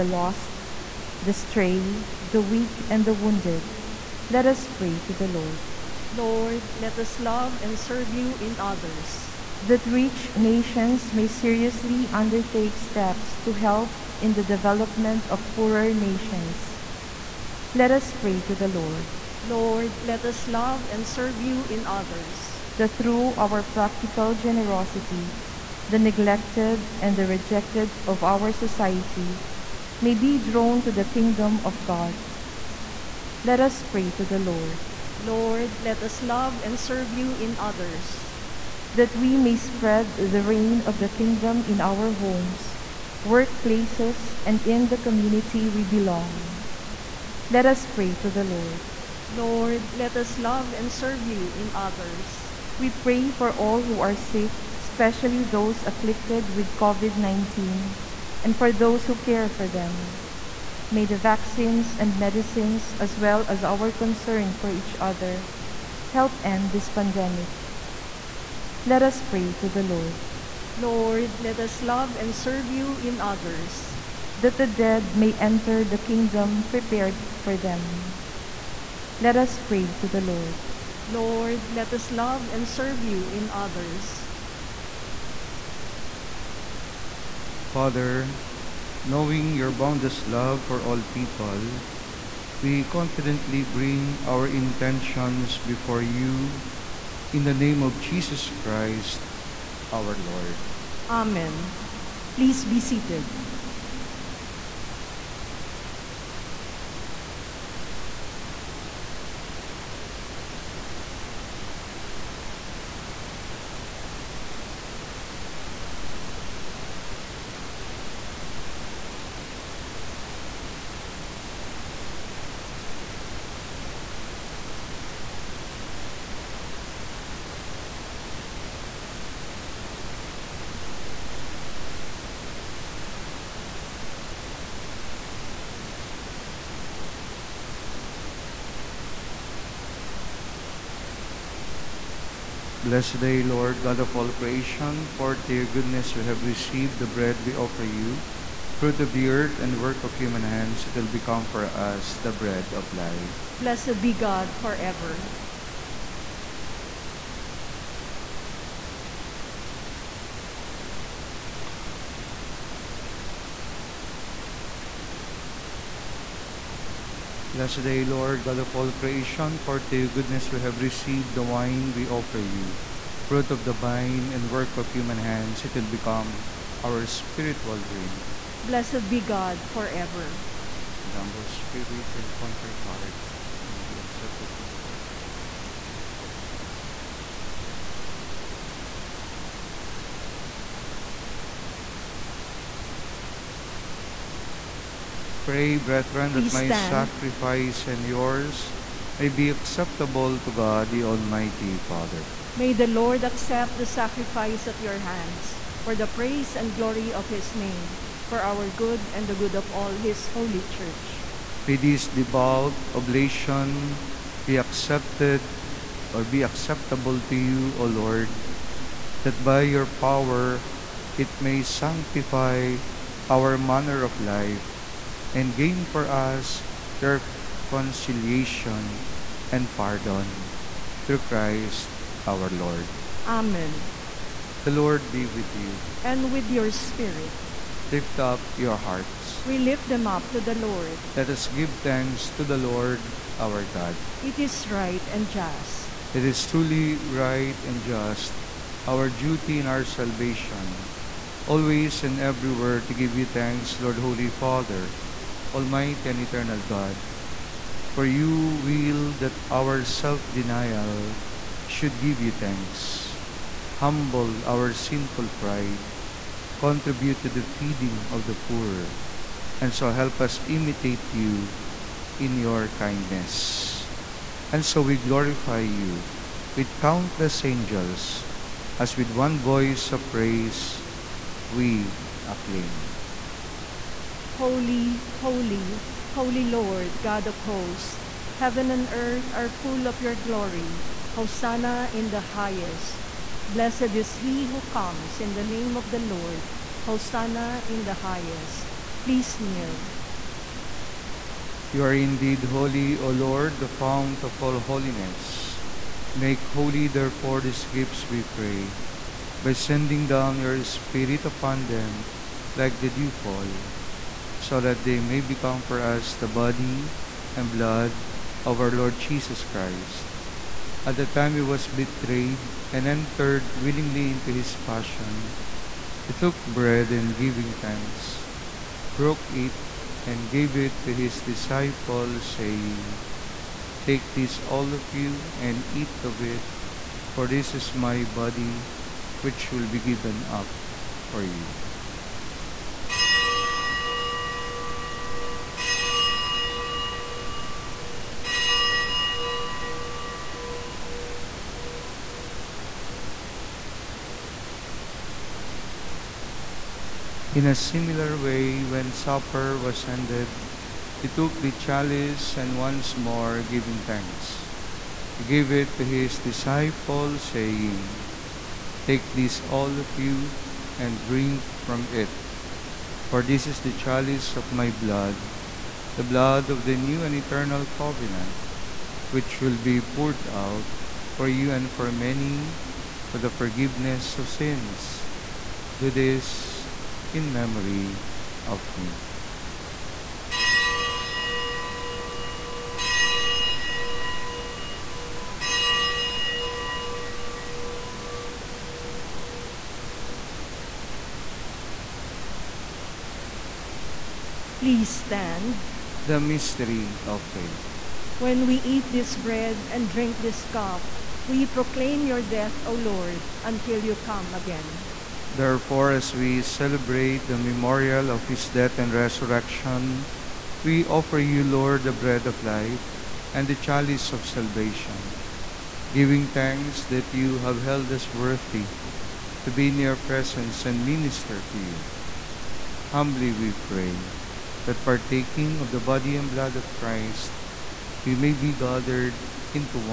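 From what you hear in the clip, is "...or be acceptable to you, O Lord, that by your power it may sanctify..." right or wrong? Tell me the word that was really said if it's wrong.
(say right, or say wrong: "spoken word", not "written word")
right.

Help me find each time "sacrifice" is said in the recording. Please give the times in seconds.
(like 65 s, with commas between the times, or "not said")
196 s, 203 s.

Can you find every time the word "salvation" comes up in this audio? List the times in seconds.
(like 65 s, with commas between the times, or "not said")
249 s, 424 s.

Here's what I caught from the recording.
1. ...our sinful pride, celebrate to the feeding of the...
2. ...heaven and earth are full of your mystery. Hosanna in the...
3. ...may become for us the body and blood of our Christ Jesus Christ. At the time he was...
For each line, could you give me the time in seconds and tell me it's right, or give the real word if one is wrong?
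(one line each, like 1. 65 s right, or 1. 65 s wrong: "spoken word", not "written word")
1. 264 s wrong: "contribute", not "celebrate"
2. 288 s wrong: "glory", not "mystery"
3. 315 s wrong: "Lord", not "Christ".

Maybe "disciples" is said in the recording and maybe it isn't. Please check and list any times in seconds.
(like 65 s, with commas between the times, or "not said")
331 s, 366 s.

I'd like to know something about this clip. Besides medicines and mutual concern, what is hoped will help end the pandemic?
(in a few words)
vaccines.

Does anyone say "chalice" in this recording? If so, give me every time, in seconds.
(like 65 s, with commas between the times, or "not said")
361 s, 373 s, 423 s.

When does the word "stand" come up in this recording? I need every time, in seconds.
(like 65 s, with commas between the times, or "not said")
196 s, 405 s.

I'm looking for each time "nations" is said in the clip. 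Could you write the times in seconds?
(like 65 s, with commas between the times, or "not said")
10 s, 15 s.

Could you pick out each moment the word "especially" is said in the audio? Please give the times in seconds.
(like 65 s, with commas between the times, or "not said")
54 s.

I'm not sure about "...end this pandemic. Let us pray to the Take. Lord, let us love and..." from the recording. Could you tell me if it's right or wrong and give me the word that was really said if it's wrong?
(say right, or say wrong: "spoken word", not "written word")
wrong: "Lord", not "Take".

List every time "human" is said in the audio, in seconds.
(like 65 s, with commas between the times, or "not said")
150 s, 174 s.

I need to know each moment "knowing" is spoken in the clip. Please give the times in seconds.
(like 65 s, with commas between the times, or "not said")
89 s.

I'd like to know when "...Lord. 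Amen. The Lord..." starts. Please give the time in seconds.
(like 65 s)
232 s.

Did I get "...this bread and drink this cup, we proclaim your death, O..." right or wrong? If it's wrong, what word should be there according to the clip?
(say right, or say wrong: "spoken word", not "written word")
right.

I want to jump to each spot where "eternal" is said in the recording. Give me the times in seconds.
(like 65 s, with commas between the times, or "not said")
256 s, 377 s.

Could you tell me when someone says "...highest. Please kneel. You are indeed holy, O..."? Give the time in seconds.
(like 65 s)
297 s.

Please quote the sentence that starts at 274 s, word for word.
And so we glorify you with countless angels, as with one voice of praise we acclaim.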